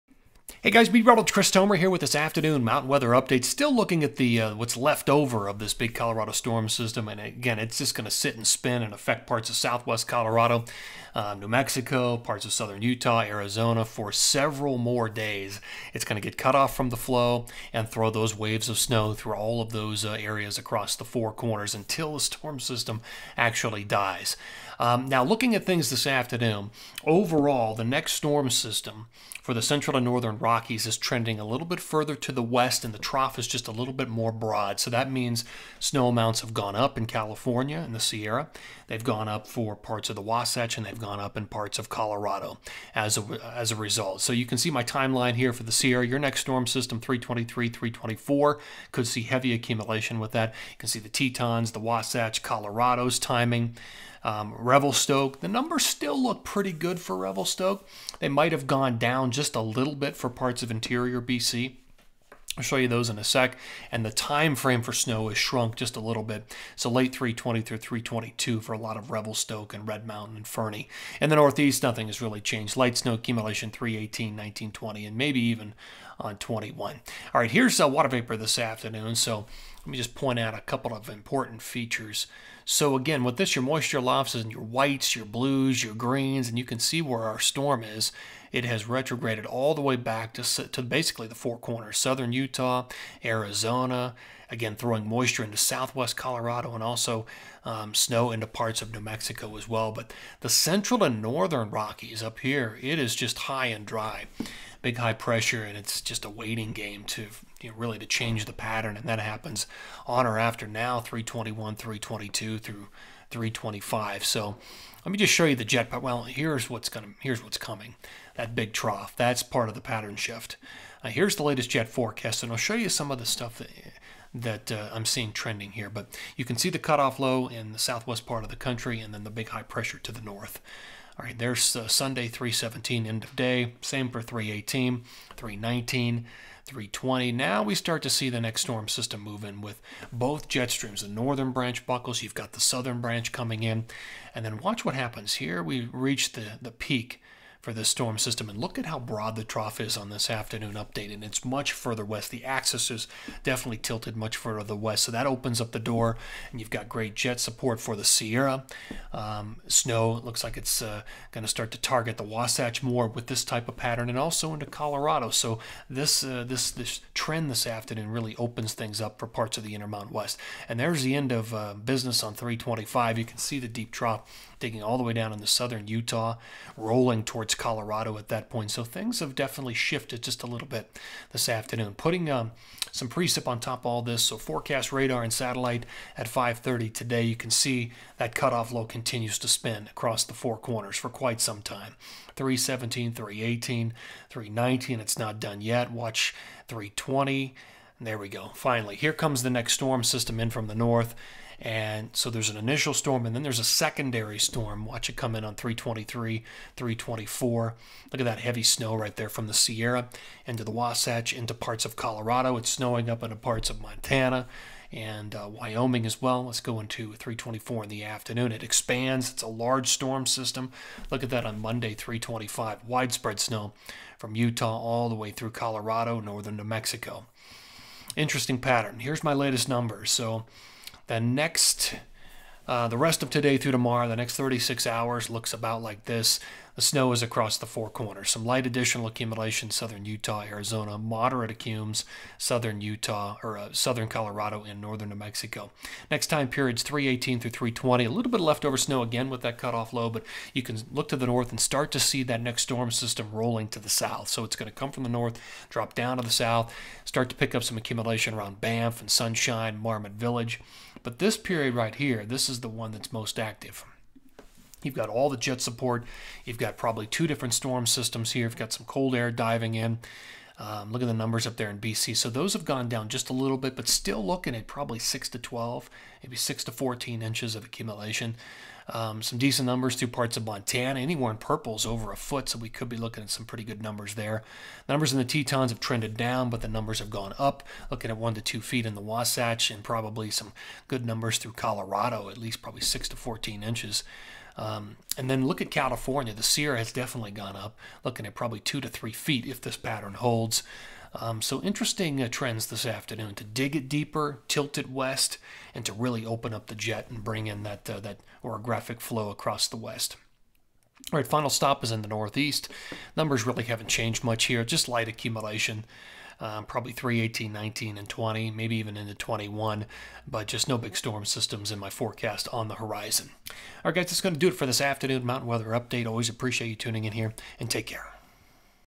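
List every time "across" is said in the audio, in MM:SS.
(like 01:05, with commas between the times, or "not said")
00:20, 03:09, 03:57, 05:09.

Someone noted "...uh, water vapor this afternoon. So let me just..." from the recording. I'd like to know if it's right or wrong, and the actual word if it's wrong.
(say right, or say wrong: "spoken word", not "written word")
right.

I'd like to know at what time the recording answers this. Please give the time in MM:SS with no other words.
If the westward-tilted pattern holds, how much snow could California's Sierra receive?
04:58.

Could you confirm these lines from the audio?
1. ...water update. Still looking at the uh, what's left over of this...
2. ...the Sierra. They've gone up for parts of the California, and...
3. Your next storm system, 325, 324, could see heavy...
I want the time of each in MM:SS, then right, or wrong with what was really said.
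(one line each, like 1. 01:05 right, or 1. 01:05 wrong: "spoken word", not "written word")
1. 00:02 wrong: "weather", not "water"
2. 00:37 wrong: "Wasatch", not "California"
3. 00:46 wrong: "323", not "325".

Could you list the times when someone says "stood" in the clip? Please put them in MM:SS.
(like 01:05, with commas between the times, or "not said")
not said.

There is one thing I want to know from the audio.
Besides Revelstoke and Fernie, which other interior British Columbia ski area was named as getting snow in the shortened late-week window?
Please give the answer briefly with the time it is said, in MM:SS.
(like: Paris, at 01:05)
Red Mountain, at 01:09.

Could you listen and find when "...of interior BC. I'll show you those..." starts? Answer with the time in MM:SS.
01:00.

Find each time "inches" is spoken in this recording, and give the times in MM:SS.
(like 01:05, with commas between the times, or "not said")
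04:37, 04:53.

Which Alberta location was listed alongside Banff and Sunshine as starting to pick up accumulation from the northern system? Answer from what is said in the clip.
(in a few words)
Marmot Village.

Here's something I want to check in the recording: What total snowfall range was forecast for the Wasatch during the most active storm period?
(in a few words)
1 to 2 feet.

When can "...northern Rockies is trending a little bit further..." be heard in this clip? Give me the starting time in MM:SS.
00:30.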